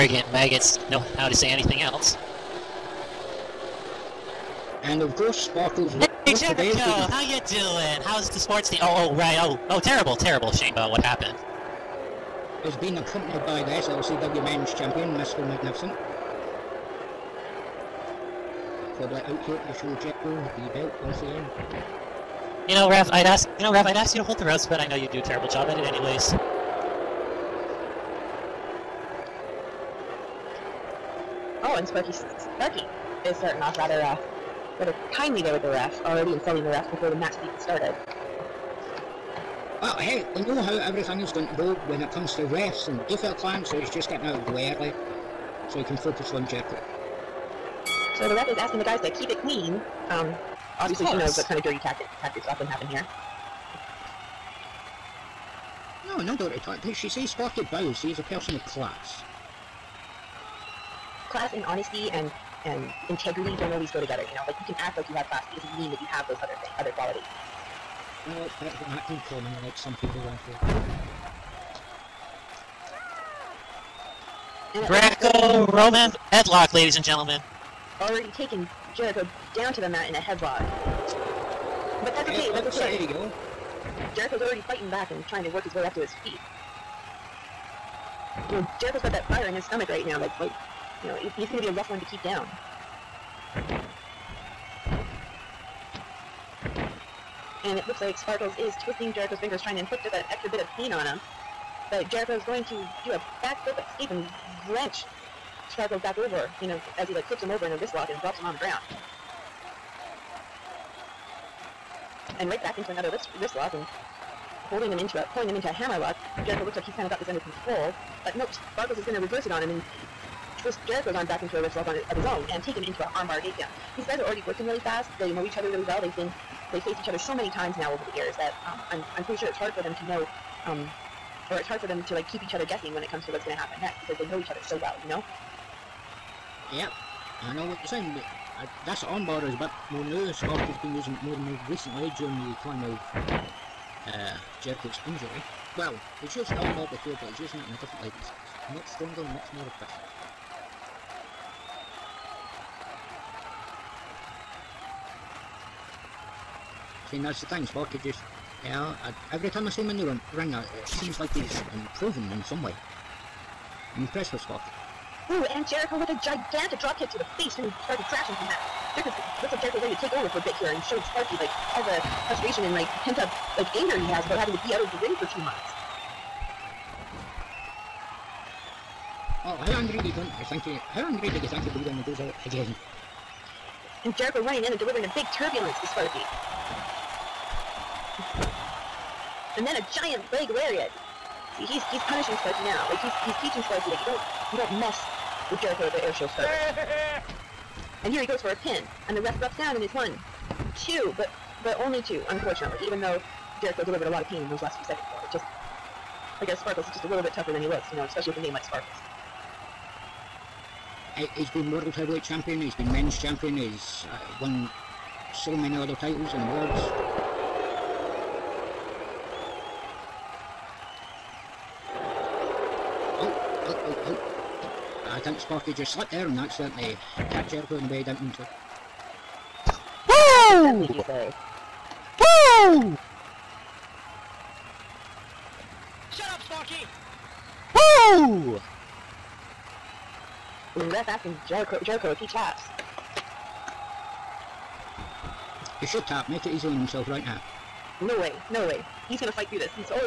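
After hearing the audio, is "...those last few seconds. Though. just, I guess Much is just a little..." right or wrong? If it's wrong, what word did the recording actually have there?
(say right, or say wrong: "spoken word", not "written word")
wrong: "Sparkles", not "Much".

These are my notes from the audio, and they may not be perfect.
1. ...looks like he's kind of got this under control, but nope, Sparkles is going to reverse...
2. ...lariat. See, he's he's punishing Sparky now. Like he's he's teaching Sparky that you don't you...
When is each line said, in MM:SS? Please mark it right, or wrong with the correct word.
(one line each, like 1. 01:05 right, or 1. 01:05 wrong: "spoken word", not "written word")
1. 01:56 right
2. 03:10 right.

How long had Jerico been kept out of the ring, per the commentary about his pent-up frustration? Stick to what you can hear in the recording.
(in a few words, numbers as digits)
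2 months.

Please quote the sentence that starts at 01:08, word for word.
Well, that, that can come in like some people around here.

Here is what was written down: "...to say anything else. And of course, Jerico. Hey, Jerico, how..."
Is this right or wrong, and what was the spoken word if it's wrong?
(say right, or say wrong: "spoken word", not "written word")
wrong: "Sparkles", not "Jerico".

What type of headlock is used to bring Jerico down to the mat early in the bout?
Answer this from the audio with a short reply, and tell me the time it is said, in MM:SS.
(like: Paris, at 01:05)
Greco Roman headlock, at 01:14.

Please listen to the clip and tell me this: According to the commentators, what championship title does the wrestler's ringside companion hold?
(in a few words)
SLCW Men's Champion.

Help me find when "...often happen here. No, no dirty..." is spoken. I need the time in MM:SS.
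00:52.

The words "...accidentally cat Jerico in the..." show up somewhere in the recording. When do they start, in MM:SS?
03:46.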